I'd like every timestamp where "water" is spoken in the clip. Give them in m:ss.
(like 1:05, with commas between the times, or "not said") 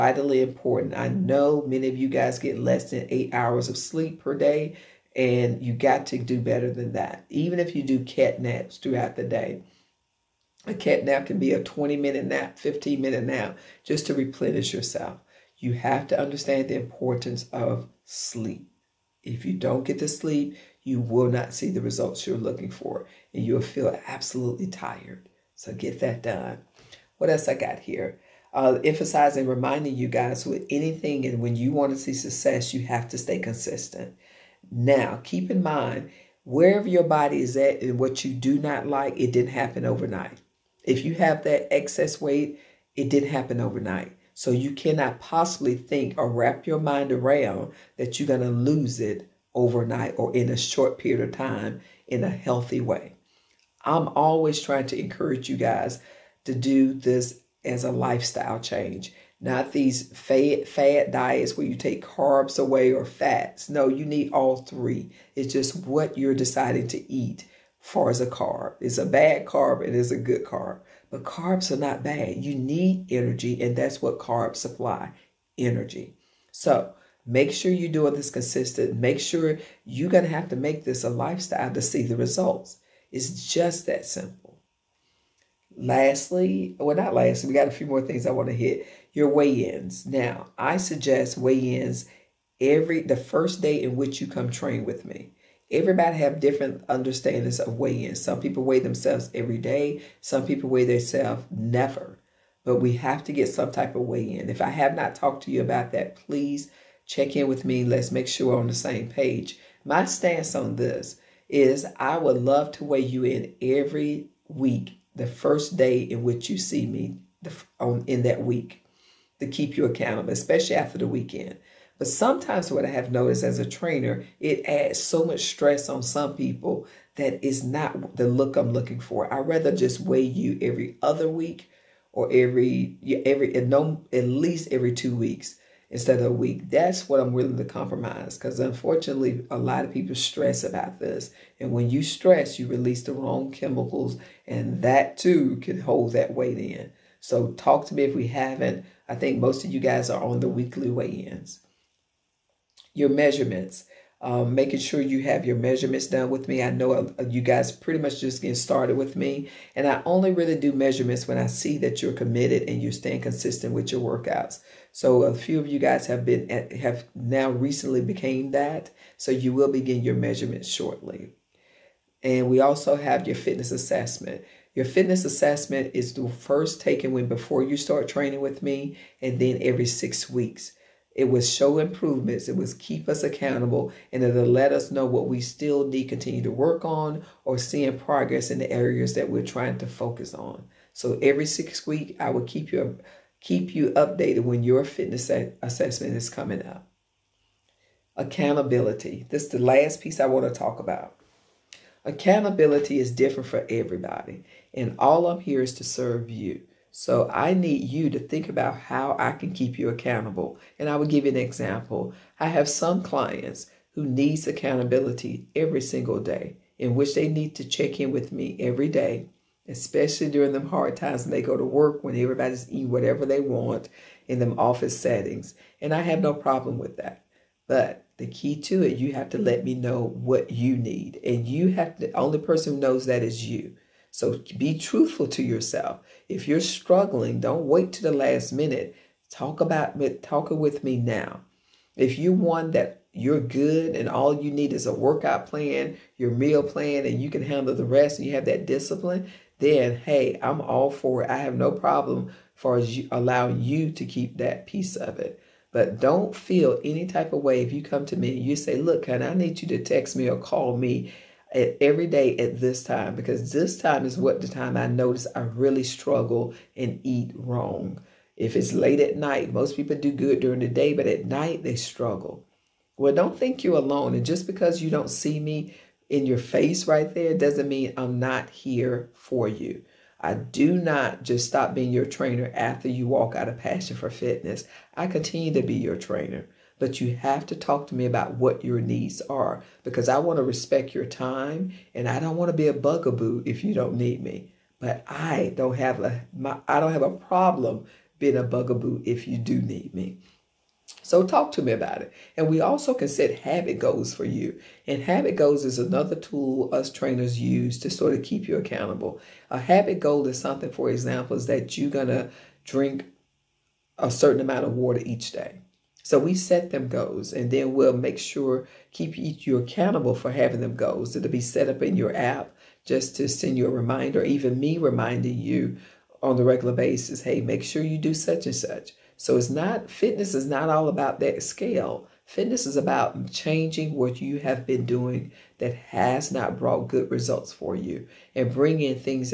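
5:14.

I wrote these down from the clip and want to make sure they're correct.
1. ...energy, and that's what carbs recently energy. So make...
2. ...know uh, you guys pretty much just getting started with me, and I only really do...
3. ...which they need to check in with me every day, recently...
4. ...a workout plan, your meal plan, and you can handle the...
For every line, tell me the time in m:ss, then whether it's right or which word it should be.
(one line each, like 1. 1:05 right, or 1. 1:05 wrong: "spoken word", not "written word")
1. 1:13 wrong: "supply", not "recently"
2. 2:36 right
3. 3:36 wrong: "especially", not "recently"
4. 4:04 right.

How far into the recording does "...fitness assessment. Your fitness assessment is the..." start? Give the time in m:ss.
2:53.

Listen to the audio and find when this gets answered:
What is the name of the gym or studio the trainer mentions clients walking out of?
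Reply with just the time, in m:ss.
4:43.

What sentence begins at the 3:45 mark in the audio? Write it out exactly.
And I have no problem with that.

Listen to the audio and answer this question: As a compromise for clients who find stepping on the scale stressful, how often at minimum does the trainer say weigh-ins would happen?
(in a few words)
Every two weeks.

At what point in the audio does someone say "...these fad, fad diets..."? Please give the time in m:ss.
0:59.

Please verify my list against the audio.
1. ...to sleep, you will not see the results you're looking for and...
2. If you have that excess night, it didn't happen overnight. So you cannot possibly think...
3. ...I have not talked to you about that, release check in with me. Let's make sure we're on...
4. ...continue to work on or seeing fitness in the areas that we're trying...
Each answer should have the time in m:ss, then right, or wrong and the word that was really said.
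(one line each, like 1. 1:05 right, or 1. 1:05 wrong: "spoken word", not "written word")
1. 0:20 right
2. 0:40 wrong: "weight", not "night"
3. 1:44 wrong: "please", not "release"
4. 3:06 wrong: "progress", not "fitness".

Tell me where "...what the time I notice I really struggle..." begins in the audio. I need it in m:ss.
4:24.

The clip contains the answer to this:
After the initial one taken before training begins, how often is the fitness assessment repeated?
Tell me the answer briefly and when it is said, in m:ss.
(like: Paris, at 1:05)
Every six weeks, at 2:59.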